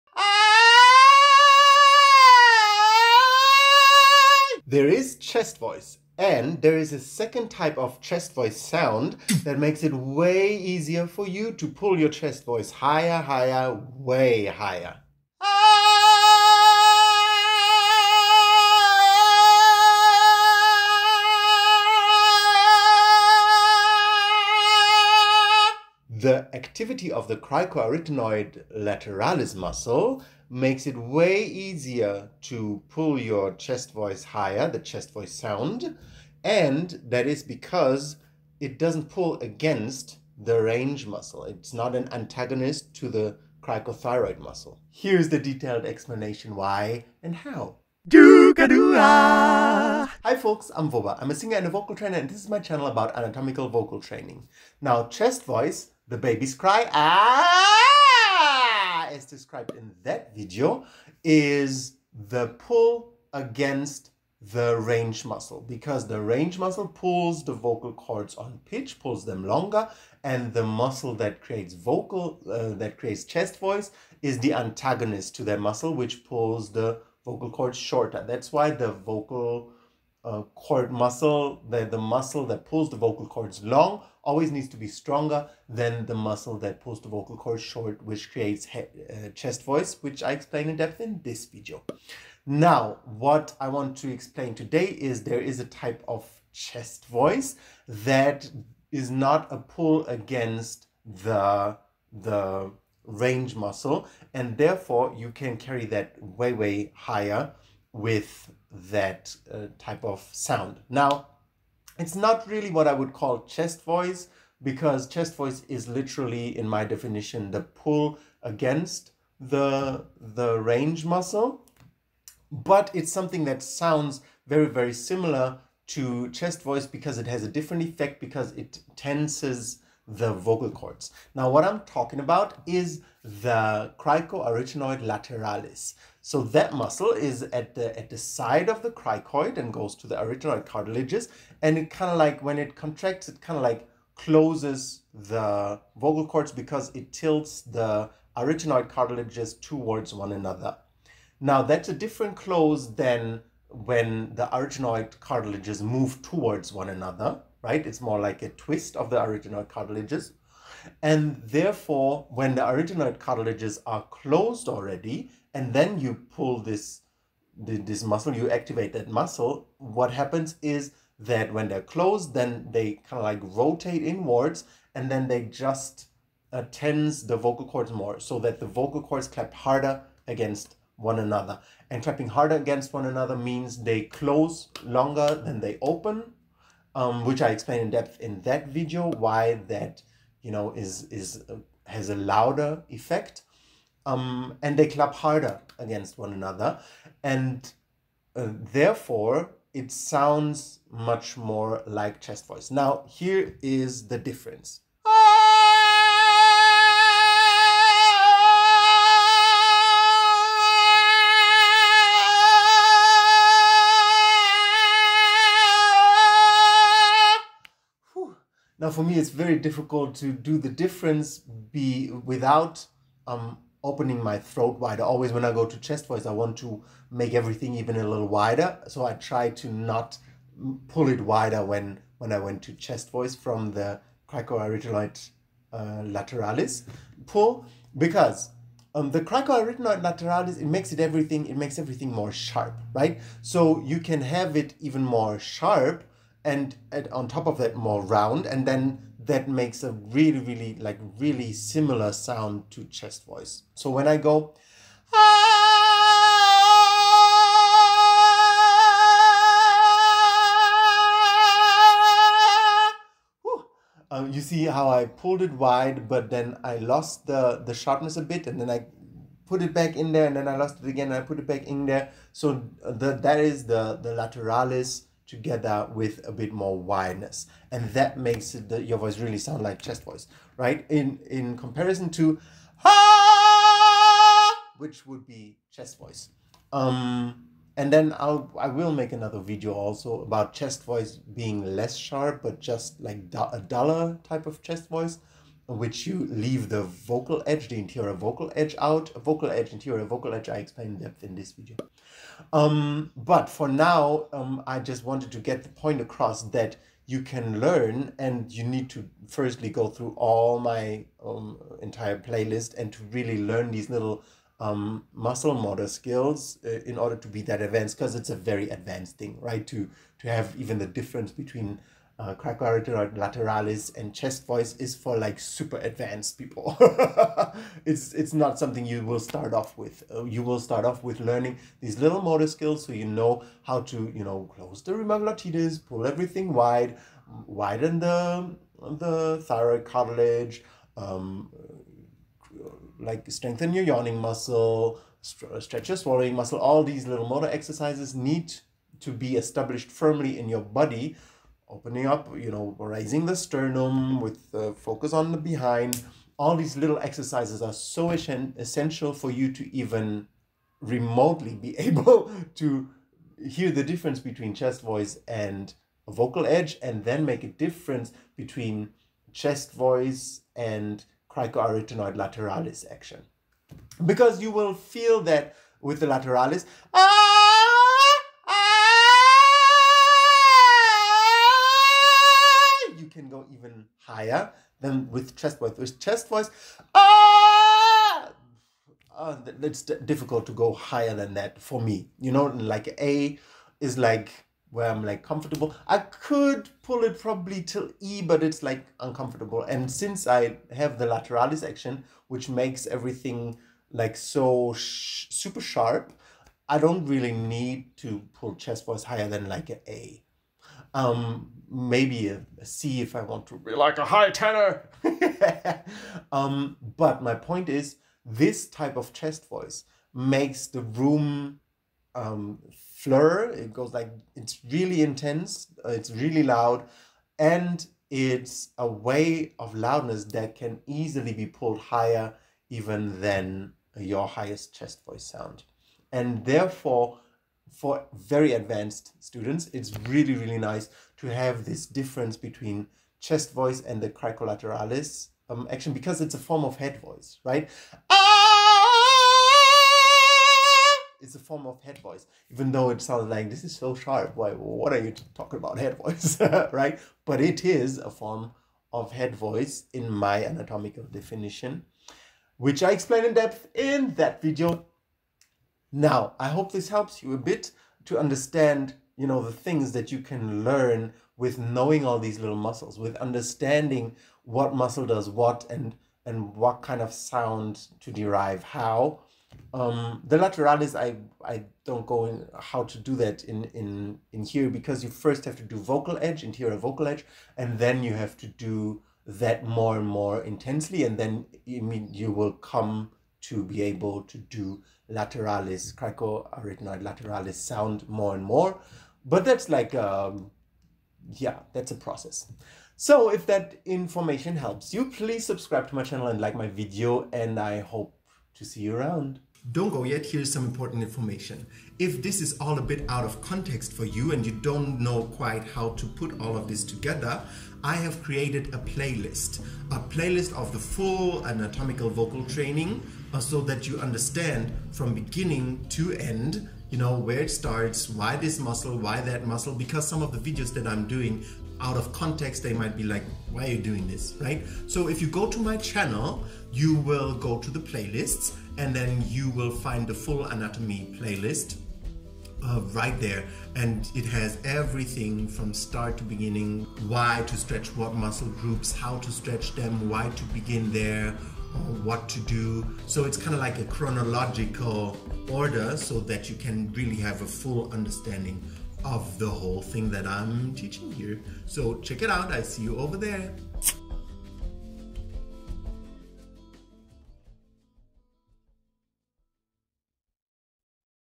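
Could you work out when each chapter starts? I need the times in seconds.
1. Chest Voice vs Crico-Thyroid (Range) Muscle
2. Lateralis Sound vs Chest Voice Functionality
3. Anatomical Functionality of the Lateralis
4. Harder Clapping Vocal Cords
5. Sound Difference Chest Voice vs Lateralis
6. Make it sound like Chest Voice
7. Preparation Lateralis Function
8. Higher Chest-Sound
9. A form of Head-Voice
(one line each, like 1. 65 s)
1. 55 s
2. 95 s
3. 133 s
4. 181 s
5. 203 s
6. 238 s
7. 303 s
8. 374 s
9. 435 s.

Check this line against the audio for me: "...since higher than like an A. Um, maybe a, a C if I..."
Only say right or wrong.
wrong.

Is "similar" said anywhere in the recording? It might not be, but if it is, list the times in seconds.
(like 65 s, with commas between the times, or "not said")
124 s, 251 s.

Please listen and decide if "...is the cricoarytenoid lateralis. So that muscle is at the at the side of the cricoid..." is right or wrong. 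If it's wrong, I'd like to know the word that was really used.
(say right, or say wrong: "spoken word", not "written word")
right.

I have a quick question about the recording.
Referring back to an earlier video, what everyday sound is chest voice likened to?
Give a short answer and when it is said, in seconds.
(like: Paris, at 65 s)
the baby's cry, at 56 s.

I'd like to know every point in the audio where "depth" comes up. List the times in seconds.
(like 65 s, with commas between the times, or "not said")
90 s, 187 s, 300 s, 463 s.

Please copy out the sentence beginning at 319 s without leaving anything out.
To, to have even the difference between uh, lateralis and chest voice is for like super advanced people.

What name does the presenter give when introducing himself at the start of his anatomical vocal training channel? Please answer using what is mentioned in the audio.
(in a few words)
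Voba.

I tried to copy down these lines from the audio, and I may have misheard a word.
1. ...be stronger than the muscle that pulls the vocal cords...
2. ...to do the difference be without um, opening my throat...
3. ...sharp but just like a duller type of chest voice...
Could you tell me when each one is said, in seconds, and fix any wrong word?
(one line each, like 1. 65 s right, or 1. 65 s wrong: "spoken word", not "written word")
1. 84 s right
2. 220 s right
3. 291 s right.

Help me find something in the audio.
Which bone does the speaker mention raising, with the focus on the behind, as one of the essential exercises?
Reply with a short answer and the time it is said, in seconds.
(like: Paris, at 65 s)
sternum, at 353 s.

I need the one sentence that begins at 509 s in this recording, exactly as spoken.
Don't go yet, here's some important information.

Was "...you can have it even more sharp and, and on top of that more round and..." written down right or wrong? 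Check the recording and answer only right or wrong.
right.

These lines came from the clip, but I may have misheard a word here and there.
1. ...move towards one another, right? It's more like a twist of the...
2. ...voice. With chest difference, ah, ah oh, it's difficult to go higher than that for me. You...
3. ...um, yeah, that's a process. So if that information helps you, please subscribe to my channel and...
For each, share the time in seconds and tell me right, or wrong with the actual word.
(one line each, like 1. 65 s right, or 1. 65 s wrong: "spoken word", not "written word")
1. 155 s right
2. 385 s wrong: "voice", not "difference"
3. 499 s right.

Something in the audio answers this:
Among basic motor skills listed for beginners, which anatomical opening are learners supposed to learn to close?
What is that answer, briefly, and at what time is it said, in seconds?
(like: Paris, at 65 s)
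rima glottidis, at 334 s.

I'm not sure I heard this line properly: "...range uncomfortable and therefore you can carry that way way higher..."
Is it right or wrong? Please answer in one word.
wrong.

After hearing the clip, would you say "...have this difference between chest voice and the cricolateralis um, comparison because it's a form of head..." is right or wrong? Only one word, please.
wrong.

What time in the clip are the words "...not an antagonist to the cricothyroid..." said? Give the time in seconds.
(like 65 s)
41 s.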